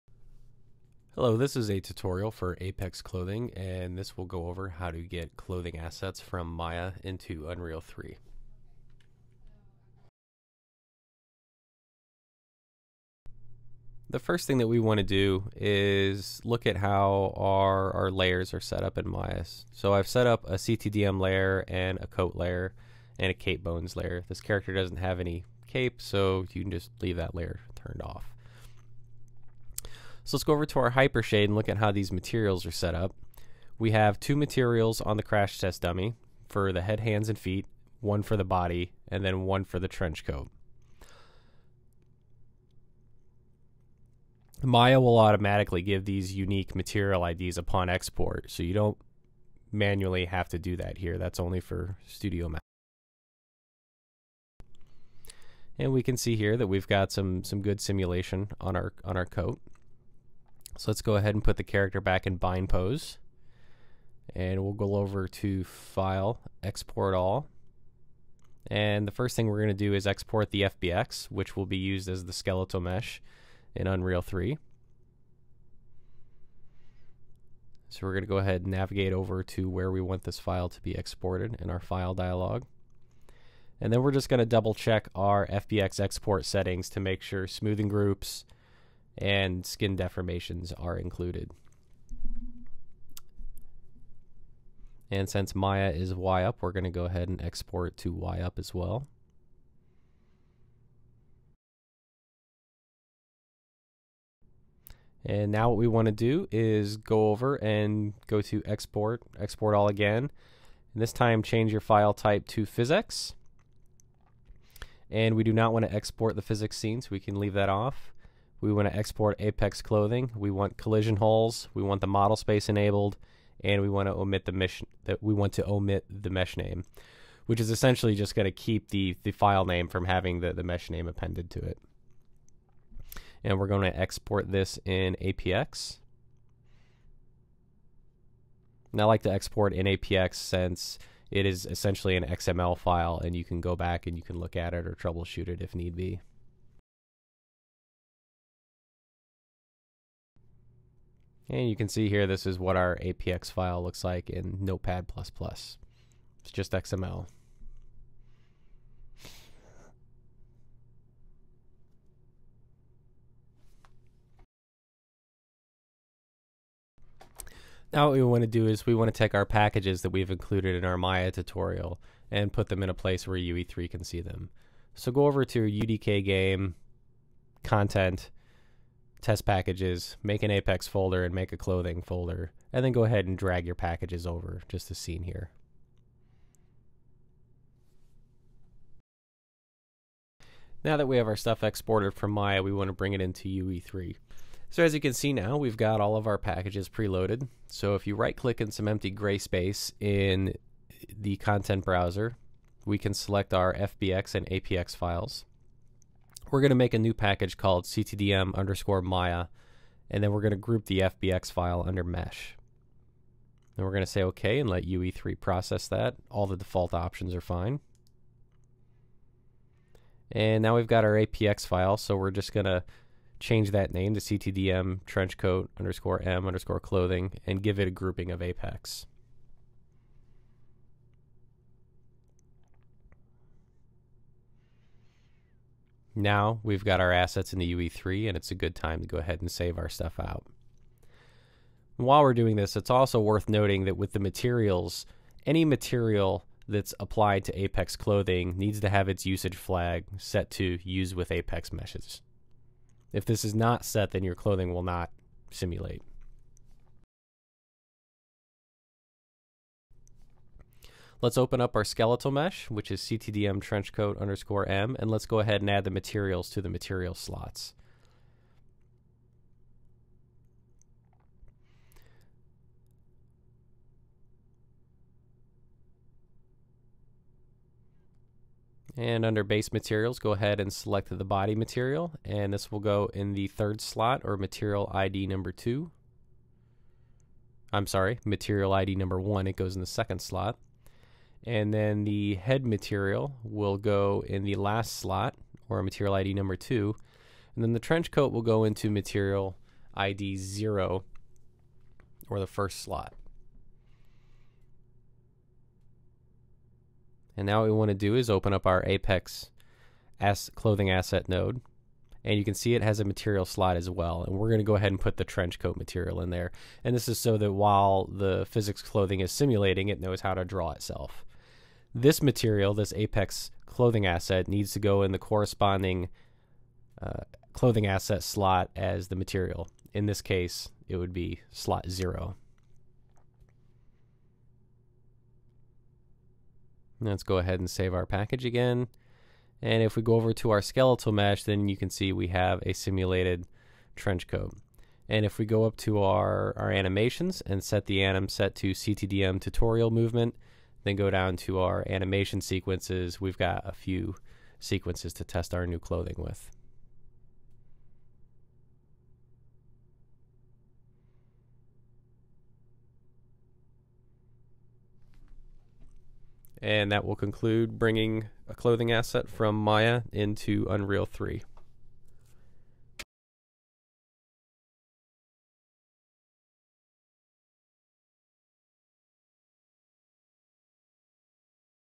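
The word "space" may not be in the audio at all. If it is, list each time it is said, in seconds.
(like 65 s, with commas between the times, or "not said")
122 s, 199 s.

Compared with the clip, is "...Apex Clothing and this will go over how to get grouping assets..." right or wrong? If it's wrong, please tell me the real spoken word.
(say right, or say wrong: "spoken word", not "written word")
wrong: "clothing", not "grouping".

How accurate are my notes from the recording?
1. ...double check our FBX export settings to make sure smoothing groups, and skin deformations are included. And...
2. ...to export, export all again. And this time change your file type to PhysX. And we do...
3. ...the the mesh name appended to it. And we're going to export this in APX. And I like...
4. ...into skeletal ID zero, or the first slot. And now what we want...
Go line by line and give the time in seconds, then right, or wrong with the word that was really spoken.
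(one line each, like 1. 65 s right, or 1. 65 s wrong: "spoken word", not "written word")
1. 84 s right
2. 108 s right
3. 130 s right
4. 298 s wrong: "material", not "skeletal".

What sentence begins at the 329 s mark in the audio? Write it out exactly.
In this case, it would be slot zero.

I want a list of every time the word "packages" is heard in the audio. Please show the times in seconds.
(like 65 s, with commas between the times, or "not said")
169 s, 179 s, 183 s, 196 s, 207 s, 338 s.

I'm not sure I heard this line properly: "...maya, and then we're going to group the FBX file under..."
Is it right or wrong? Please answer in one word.
right.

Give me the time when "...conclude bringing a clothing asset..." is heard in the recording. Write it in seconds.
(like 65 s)
367 s.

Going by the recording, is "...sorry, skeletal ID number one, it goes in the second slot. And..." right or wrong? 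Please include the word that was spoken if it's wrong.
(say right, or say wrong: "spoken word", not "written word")
wrong: "material", not "skeletal".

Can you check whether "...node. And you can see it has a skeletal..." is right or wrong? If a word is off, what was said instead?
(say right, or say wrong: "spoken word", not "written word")
wrong: "material", not "skeletal".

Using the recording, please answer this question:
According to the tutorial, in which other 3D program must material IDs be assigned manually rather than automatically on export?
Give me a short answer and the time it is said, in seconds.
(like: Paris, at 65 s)
Studio Max, at 52 s.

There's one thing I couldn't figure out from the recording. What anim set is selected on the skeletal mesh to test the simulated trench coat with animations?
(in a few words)
CTDM tutorial movement.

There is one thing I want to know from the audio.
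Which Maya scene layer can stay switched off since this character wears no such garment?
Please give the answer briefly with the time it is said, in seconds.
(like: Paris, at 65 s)
Cape bones layer, at 23 s.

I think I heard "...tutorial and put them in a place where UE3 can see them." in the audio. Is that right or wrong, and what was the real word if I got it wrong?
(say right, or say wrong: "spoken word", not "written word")
right.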